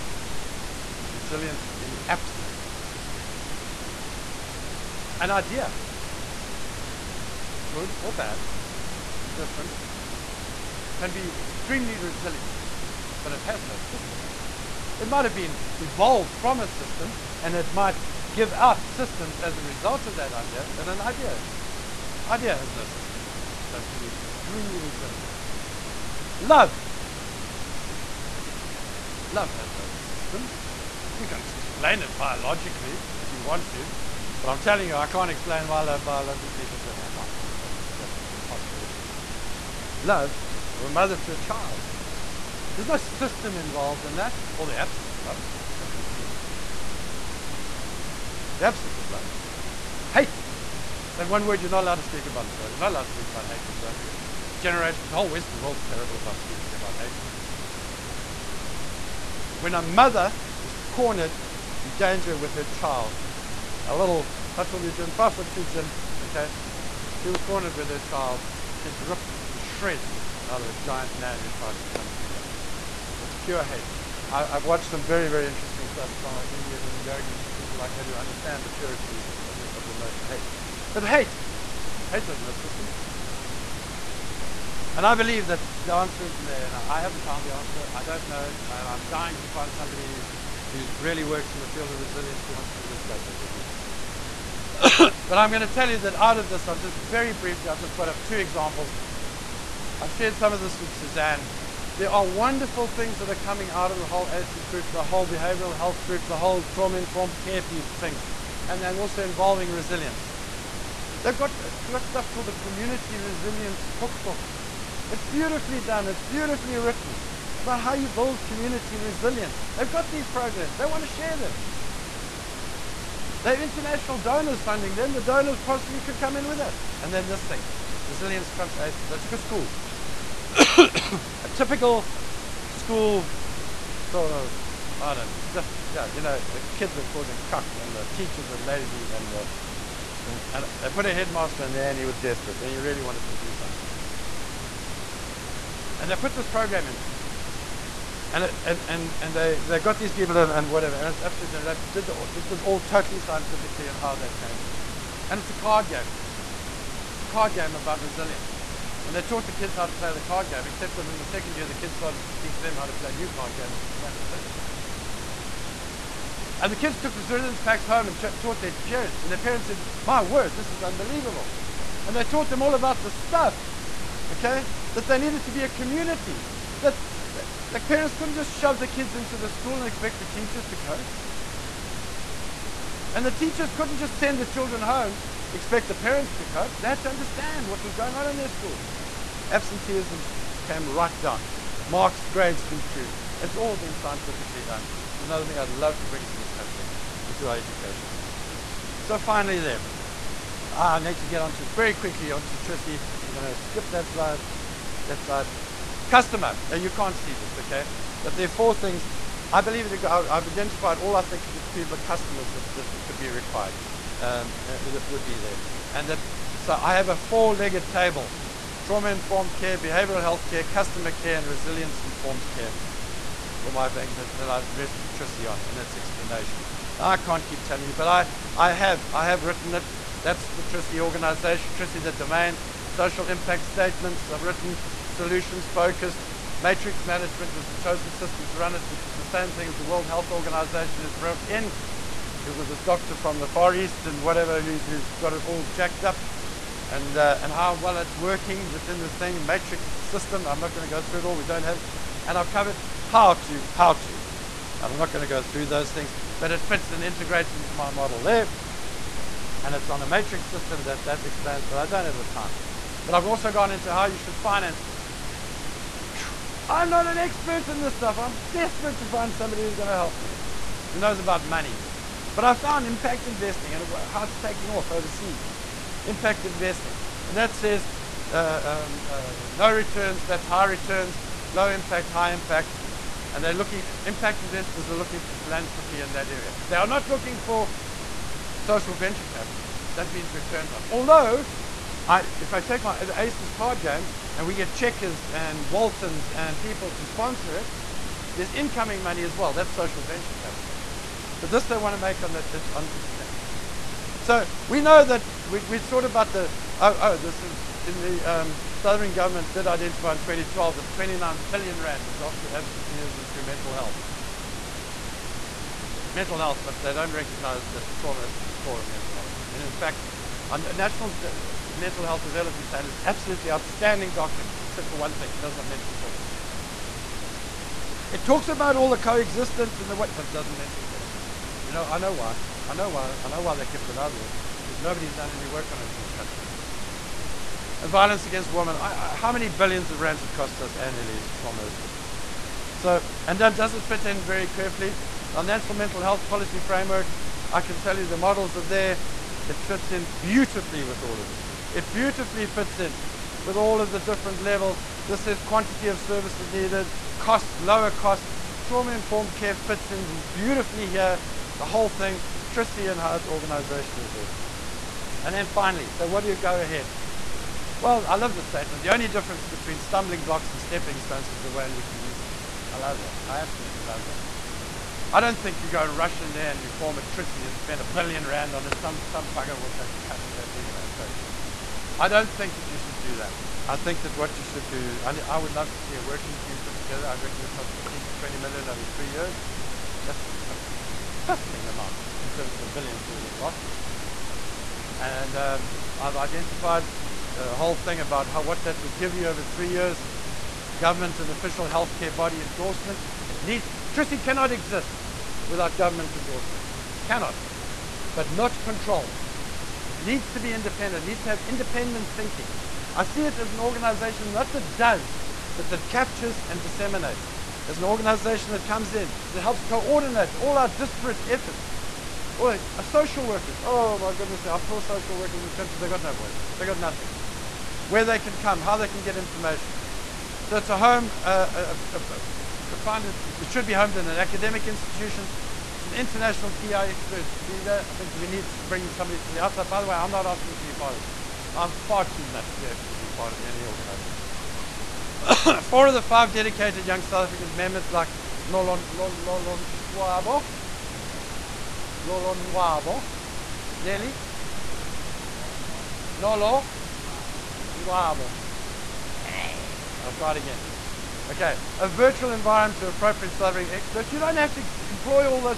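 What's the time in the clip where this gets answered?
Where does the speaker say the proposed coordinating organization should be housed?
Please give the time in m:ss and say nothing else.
7:14.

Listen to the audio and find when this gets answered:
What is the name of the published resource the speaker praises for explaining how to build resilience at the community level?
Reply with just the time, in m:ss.
1:52.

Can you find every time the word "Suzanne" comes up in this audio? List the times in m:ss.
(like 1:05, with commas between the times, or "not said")
1:40.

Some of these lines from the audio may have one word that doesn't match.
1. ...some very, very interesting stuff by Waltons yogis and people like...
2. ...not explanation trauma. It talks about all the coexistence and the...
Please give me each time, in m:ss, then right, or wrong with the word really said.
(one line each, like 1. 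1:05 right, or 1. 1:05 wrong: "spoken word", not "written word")
1. 1:14 wrong: "Indian", not "Waltons"
2. 5:25 wrong: "mention", not "explanation".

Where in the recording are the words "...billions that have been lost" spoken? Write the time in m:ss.
6:32.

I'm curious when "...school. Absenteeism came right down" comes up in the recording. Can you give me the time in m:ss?
3:08.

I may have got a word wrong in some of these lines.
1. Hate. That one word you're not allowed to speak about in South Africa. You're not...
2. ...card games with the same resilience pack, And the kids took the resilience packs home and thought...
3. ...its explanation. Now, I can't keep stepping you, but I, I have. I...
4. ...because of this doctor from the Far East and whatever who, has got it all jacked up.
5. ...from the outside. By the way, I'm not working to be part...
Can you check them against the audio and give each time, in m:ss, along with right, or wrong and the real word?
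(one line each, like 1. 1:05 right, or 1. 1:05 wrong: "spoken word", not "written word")
1. 0:50 right
2. 2:43 wrong: "taught", not "thought"
3. 3:45 wrong: "telling", not "stepping"
4. 4:02 right
5. 7:19 wrong: "asking", not "working".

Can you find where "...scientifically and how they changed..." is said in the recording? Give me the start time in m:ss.
2:33.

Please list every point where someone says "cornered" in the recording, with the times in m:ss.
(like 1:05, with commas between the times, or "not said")
1:00, 1:07.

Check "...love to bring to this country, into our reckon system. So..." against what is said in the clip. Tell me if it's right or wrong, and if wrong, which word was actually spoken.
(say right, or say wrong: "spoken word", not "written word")
wrong: "education", not "reckon".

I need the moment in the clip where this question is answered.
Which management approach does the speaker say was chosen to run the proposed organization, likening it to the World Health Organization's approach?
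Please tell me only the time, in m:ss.
3:56.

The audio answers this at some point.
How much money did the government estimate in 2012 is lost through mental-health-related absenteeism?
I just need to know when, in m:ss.
5:10.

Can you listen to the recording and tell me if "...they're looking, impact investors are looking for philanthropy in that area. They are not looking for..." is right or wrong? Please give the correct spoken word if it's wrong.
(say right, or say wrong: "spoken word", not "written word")
right.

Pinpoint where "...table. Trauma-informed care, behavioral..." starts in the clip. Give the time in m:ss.
3:37.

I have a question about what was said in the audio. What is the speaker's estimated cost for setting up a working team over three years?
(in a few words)
15 to 20 million.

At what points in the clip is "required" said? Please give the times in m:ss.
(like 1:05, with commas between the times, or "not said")
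3:33.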